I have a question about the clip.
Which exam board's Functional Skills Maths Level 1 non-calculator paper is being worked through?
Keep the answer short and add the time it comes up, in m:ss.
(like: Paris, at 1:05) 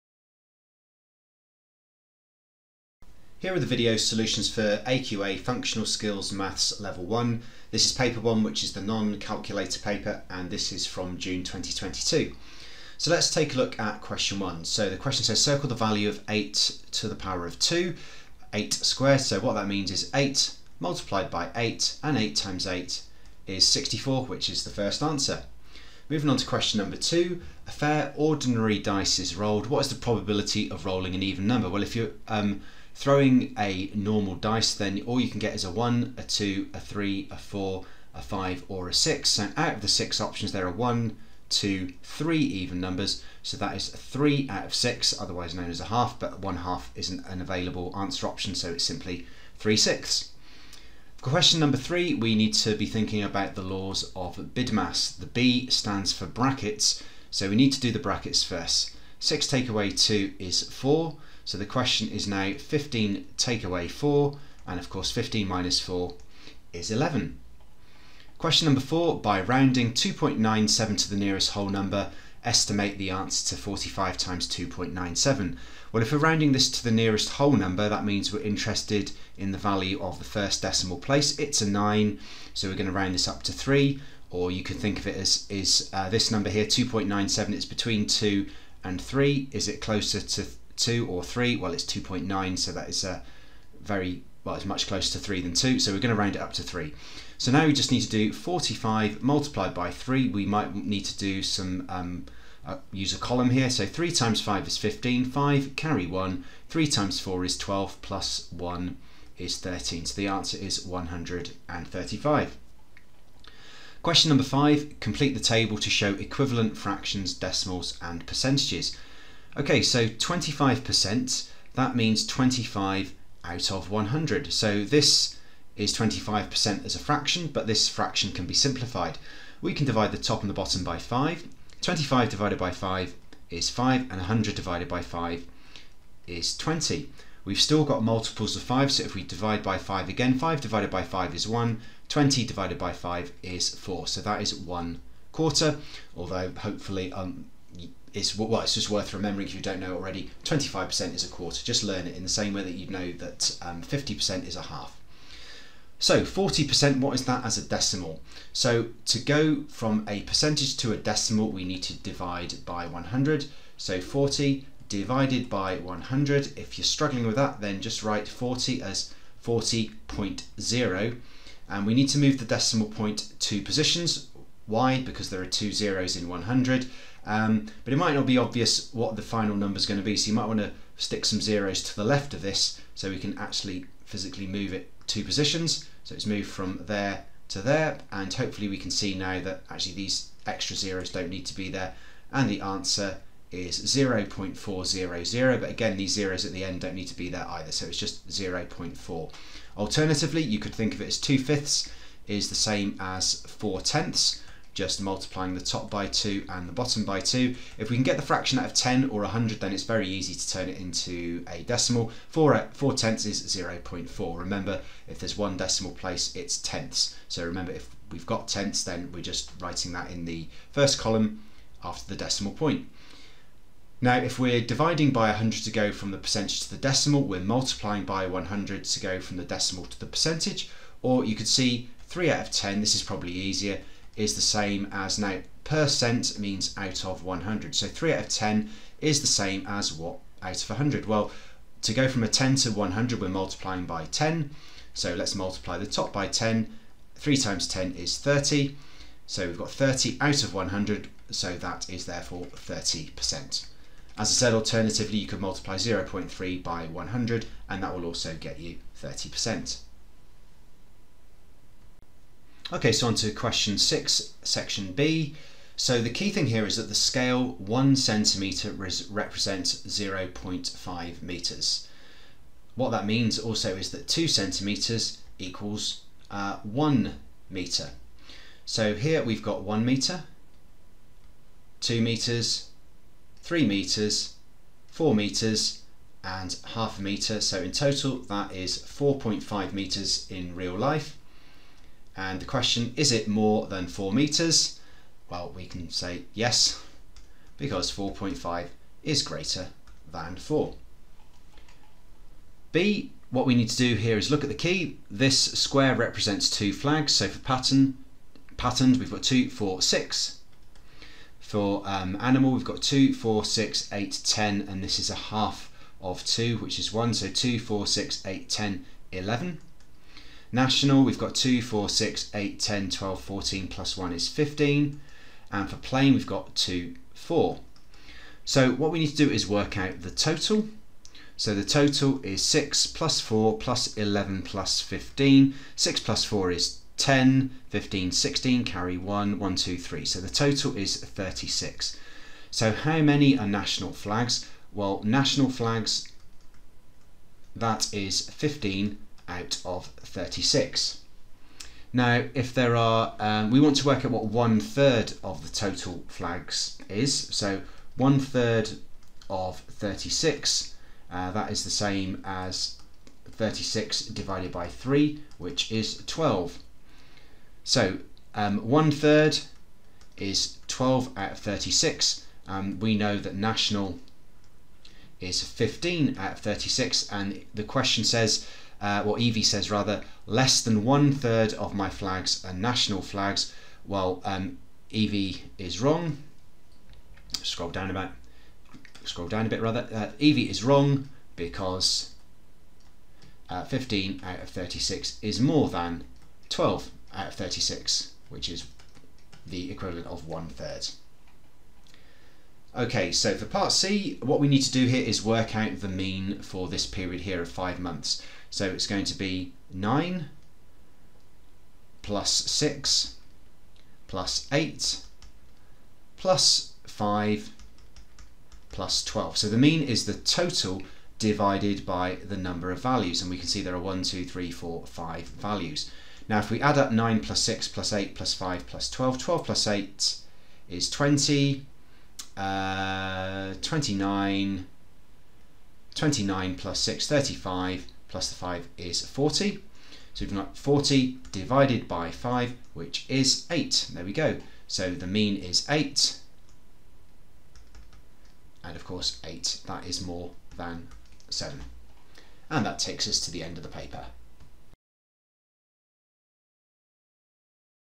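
AQA, at 0:04.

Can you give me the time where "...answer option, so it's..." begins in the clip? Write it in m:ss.
0:47.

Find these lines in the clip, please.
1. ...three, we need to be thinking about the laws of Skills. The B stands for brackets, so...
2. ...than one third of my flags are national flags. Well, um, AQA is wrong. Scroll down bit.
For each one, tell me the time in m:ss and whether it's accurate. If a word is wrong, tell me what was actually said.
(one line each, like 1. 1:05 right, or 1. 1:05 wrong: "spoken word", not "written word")
1. 0:51 wrong: "BIDMAS", not "Skills"
2. 6:20 wrong: "Evie", not "AQA".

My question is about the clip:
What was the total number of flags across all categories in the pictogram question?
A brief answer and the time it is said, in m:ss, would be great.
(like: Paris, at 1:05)
36, at 5:40.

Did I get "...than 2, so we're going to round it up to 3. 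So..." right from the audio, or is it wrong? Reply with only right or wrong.
right.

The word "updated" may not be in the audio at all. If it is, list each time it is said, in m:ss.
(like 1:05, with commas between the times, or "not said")
not said.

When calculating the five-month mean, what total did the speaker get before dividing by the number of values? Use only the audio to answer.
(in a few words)
40.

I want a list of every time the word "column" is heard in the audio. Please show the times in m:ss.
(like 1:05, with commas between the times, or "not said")
1:43, 3:40.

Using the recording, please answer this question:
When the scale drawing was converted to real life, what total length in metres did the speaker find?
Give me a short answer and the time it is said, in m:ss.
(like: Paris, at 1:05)
4.5 metres, at 4:48.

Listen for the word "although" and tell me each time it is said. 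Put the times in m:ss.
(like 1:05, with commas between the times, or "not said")
2:26.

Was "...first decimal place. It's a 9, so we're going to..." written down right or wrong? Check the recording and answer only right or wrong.
right.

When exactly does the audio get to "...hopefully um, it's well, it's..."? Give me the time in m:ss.
2:26.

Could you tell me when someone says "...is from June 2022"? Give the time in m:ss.
0:10.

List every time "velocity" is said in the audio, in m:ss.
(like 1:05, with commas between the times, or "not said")
not said.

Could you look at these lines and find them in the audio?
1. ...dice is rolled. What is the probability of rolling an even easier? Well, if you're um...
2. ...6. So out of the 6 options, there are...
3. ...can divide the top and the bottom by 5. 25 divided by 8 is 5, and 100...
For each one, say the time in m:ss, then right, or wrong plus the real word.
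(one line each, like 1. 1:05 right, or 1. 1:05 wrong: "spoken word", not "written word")
1. 0:28 wrong: "number", not "easier"
2. 0:38 right
3. 2:09 wrong: "5", not "8".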